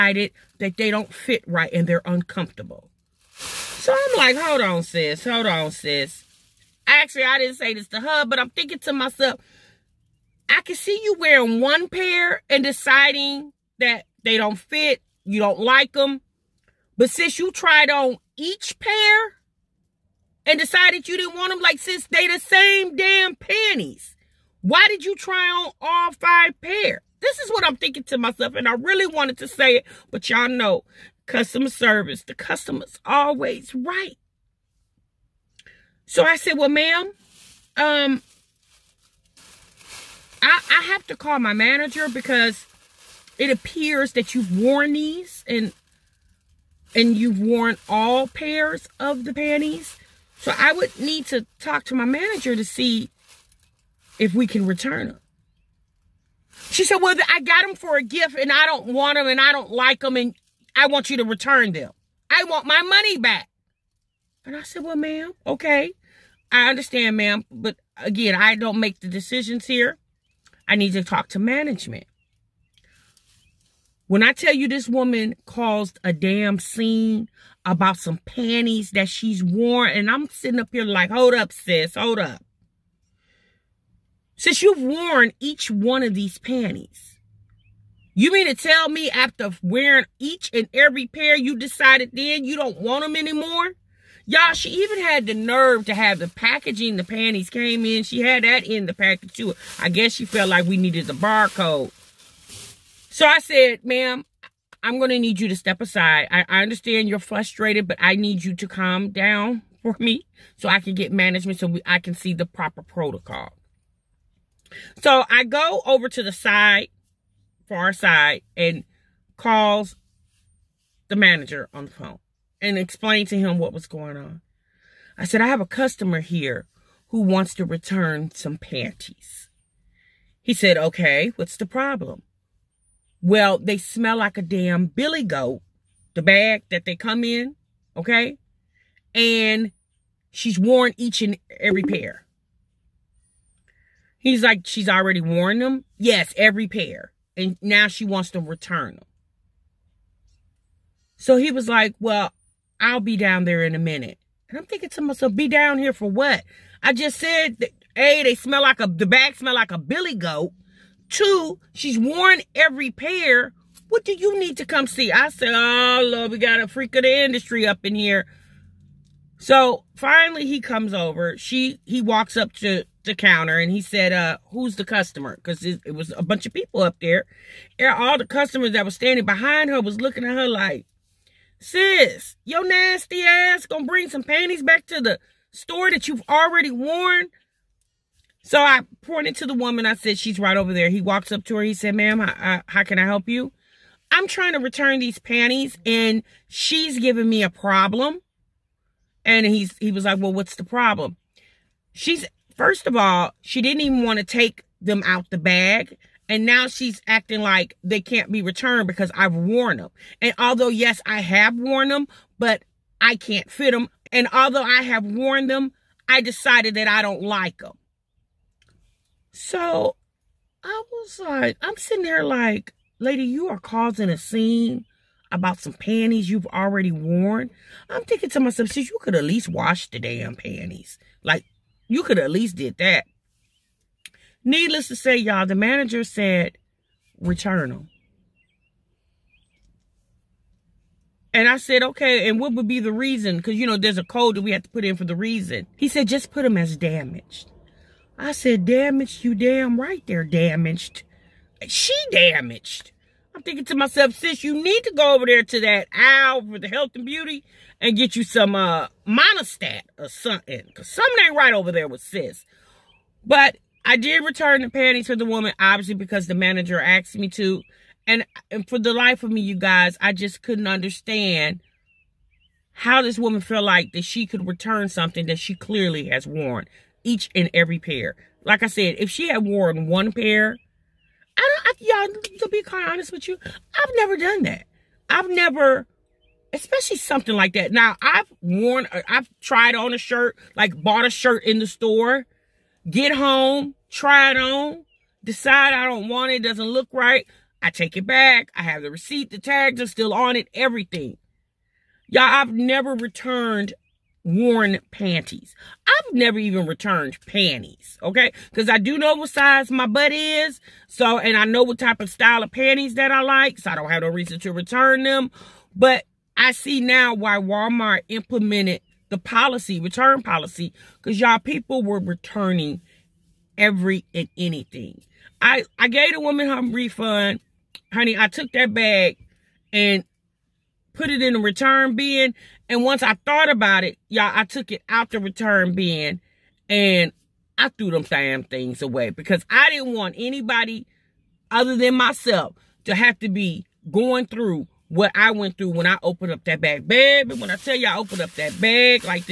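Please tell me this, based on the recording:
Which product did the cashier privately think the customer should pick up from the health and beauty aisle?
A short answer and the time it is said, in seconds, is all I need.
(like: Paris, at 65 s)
Monistat, at 259 s.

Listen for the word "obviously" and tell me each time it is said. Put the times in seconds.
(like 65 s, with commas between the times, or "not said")
265 s.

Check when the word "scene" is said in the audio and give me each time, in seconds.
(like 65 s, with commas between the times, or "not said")
76 s, 224 s.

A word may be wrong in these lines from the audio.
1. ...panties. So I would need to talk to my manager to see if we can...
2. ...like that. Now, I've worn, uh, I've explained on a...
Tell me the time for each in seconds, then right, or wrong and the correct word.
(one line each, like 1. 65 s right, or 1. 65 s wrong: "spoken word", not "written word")
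1. 49 s right
2. 287 s wrong: "tried", not "explained".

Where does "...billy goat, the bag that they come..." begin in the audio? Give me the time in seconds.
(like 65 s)
134 s.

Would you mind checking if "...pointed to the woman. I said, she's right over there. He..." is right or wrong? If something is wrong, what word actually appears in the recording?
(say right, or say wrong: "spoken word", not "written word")
right.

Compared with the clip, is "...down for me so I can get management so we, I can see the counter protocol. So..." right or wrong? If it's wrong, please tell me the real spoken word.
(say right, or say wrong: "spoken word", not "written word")
wrong: "proper", not "counter".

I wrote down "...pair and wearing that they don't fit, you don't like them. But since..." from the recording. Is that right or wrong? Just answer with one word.
wrong.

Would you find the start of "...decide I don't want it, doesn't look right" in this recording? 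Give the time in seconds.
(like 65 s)
295 s.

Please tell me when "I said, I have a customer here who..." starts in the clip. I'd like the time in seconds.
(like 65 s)
125 s.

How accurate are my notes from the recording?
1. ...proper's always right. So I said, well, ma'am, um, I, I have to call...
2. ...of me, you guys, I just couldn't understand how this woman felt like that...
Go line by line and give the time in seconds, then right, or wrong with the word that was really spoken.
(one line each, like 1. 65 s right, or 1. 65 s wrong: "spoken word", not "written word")
1. 32 s wrong: "customer", not "proper"
2. 269 s right.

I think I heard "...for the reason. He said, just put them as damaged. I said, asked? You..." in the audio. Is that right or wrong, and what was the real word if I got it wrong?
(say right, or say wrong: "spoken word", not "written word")
wrong: "damaged", not "asked".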